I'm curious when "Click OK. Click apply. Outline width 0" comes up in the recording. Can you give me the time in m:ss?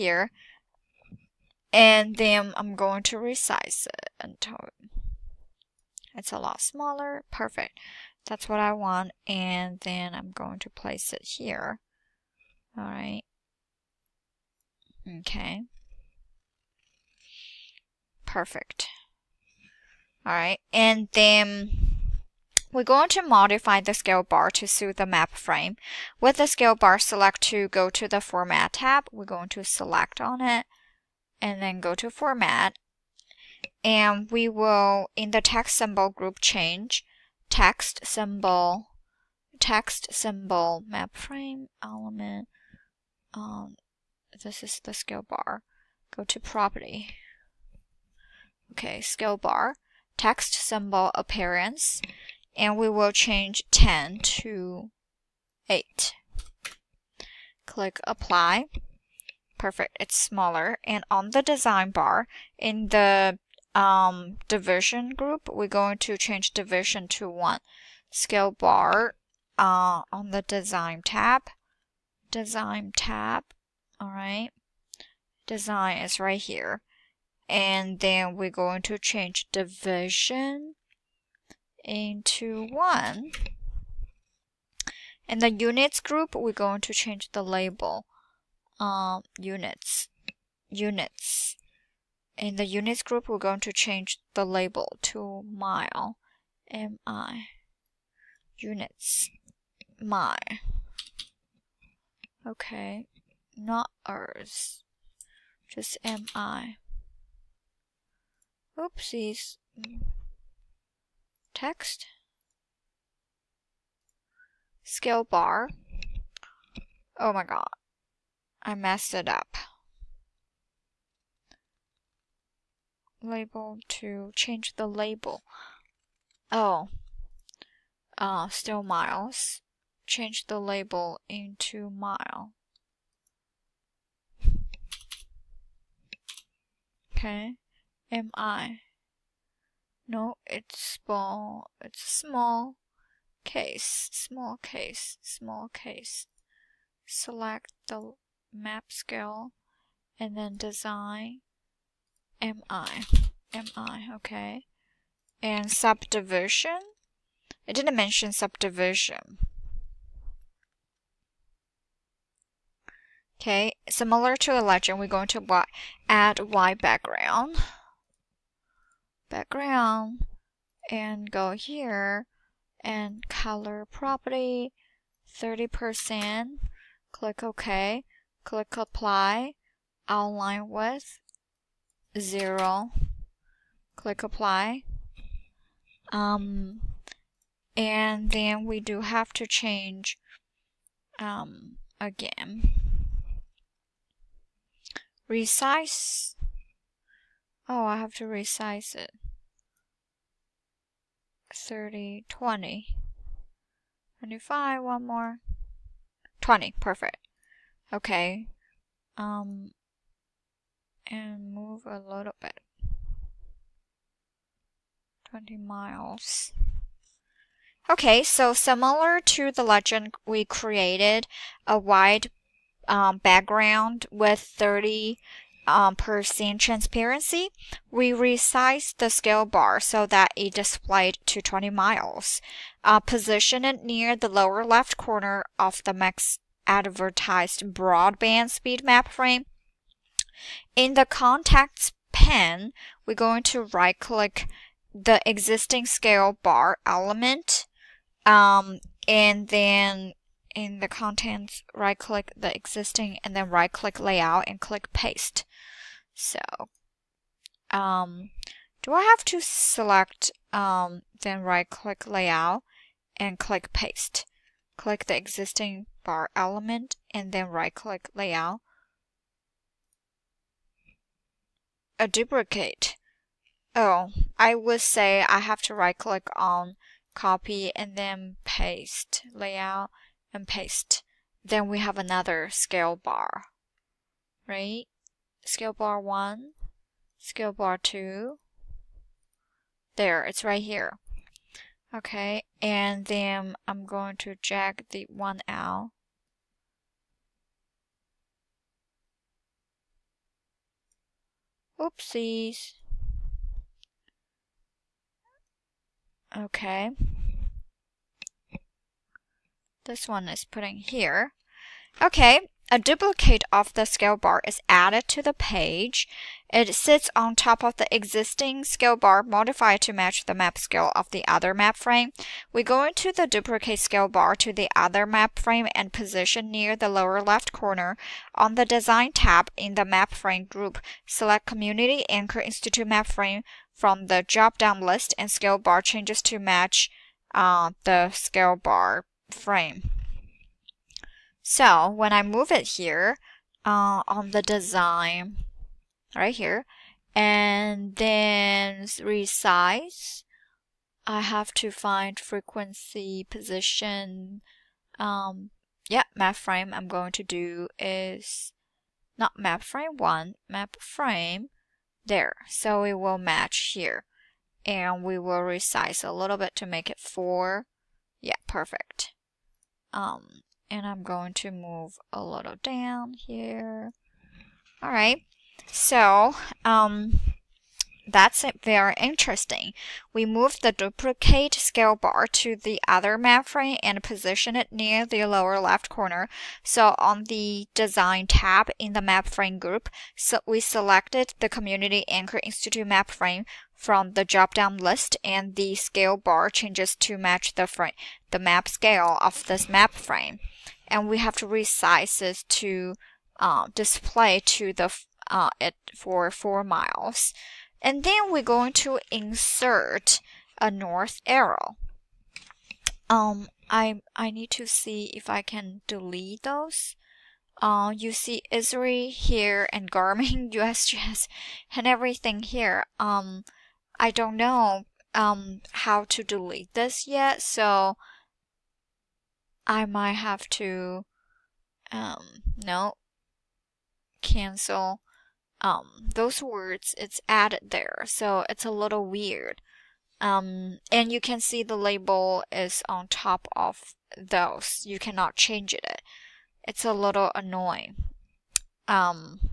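2:57.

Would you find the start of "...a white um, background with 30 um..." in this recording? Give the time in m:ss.
3:41.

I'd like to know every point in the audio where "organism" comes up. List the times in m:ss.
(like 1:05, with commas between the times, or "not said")
not said.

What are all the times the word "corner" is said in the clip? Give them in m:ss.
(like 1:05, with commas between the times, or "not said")
3:54, 5:27, 6:25.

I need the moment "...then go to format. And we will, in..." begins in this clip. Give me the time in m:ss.
0:31.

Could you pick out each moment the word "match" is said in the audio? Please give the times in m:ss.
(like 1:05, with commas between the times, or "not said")
5:19, 5:36, 6:03, 6:37.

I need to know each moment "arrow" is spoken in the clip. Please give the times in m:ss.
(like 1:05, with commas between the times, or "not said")
6:51.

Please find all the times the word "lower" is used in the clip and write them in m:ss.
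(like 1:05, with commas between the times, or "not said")
3:54, 5:26, 6:25.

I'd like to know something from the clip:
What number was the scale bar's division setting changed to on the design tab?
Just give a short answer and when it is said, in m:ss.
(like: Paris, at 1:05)
1, at 1:06.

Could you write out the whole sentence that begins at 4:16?
So, um, do I have to select, um, then right click layout and click paste?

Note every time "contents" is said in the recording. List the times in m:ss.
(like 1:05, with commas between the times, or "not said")
4:01, 4:10.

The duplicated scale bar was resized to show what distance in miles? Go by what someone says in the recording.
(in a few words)
4 miles.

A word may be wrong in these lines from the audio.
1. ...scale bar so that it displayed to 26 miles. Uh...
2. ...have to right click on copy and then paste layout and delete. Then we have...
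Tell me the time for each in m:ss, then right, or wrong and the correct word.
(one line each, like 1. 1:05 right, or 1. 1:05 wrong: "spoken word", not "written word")
1. 3:49 wrong: "20", not "26"
2. 4:35 wrong: "paste", not "delete".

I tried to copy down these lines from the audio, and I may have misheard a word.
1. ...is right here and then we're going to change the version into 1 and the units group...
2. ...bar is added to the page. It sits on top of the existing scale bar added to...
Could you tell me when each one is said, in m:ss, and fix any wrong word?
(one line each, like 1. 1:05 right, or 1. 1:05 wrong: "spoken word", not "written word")
1. 1:15 right
2. 5:14 wrong: "modified", not "added".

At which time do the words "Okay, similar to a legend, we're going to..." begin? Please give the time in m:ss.
2:43.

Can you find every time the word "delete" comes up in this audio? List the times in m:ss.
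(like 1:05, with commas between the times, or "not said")
6:55, 7:06.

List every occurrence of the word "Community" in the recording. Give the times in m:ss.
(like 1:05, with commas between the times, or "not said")
5:31, 6:31.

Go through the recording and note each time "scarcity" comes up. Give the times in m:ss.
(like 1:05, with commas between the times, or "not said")
not said.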